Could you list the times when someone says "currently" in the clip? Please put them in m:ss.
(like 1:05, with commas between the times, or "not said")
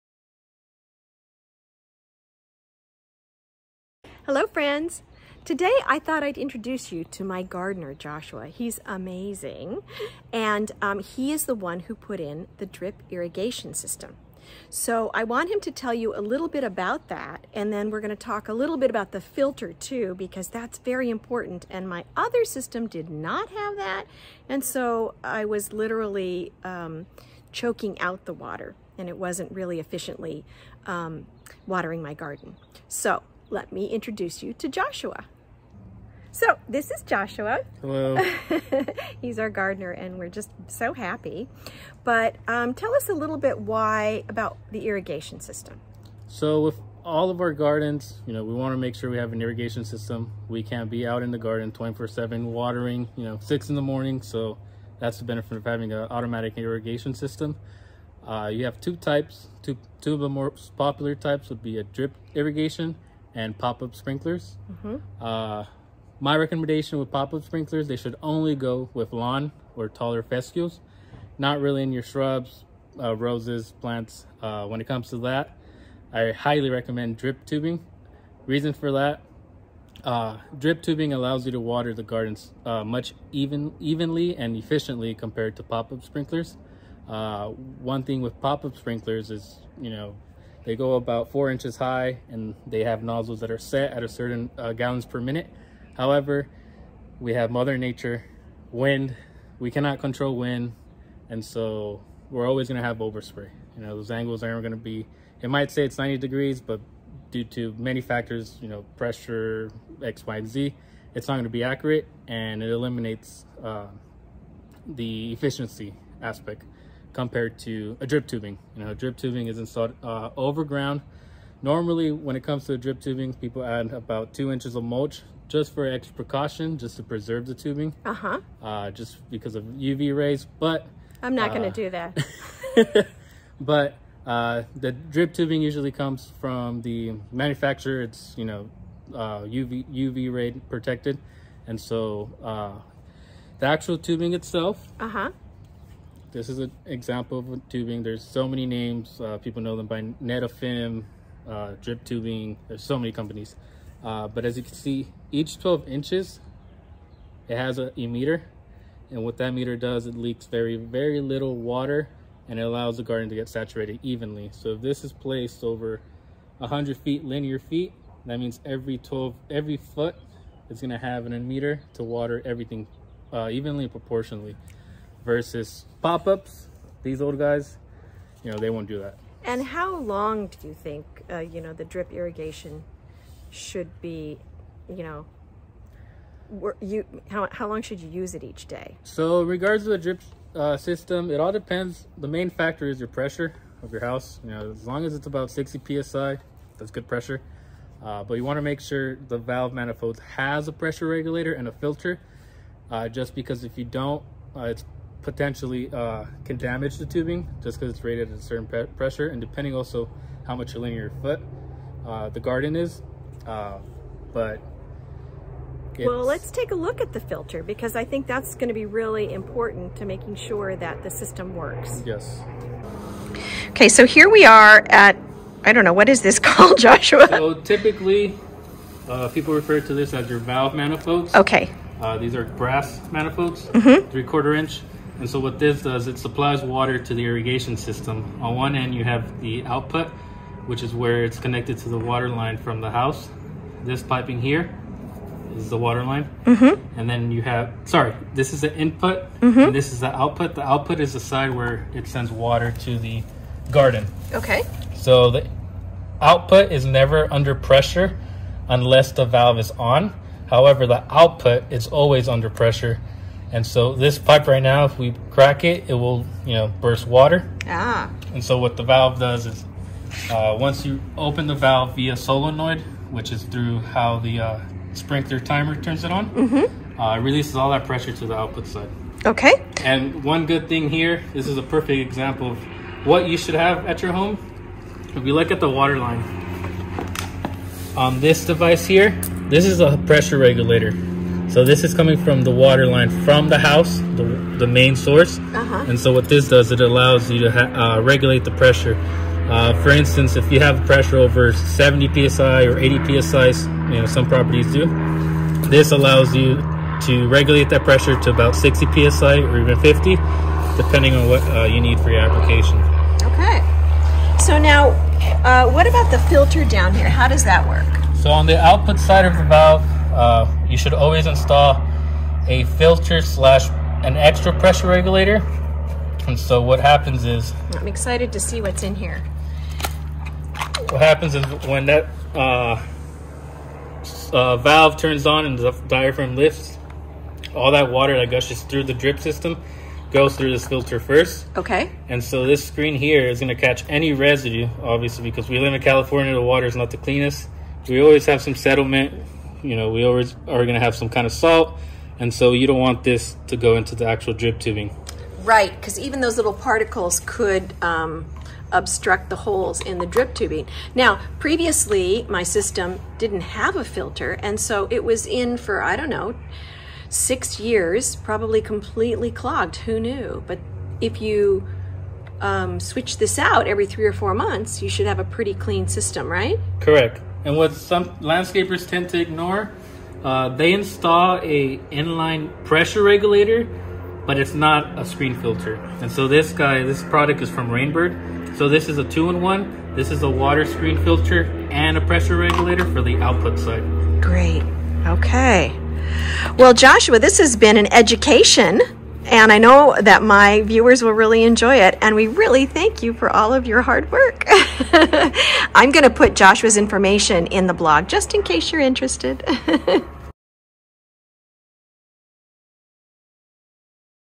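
not said.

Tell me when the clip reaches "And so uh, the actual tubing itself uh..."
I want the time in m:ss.
2:21.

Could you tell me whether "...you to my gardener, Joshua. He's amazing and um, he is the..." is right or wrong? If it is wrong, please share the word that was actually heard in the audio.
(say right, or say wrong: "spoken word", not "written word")
right.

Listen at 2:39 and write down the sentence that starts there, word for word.
And what that meter does, it leaks very, very little water and it allows the garden to get saturated evenly.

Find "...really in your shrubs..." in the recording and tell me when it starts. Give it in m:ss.
1:11.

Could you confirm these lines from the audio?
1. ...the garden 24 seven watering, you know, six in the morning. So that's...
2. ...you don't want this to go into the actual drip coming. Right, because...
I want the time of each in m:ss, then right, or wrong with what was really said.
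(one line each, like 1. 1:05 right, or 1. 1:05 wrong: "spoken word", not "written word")
1. 0:51 right
2. 5:52 wrong: "tubing", not "coming".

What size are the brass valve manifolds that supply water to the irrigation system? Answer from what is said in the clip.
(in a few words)
three quarter inch.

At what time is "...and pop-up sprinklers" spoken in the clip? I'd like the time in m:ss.
1:03.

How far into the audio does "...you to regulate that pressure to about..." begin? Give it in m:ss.
5:06.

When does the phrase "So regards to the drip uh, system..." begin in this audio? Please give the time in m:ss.
3:09.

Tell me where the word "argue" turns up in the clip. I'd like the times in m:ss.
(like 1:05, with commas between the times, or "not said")
not said.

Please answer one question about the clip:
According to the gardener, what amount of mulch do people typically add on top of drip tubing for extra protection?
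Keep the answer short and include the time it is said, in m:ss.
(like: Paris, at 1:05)
2 inches, at 2:04.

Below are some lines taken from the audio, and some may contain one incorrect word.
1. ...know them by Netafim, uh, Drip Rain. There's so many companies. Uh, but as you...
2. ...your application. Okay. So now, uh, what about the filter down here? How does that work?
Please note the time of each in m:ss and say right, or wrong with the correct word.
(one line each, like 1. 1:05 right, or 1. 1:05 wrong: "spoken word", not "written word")
1. 2:29 wrong: "Tubing", not "Rain"
2. 5:12 right.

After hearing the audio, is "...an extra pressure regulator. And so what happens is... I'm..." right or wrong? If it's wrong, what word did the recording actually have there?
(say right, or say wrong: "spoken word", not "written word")
right.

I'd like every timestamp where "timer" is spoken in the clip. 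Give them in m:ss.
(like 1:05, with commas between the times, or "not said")
4:35.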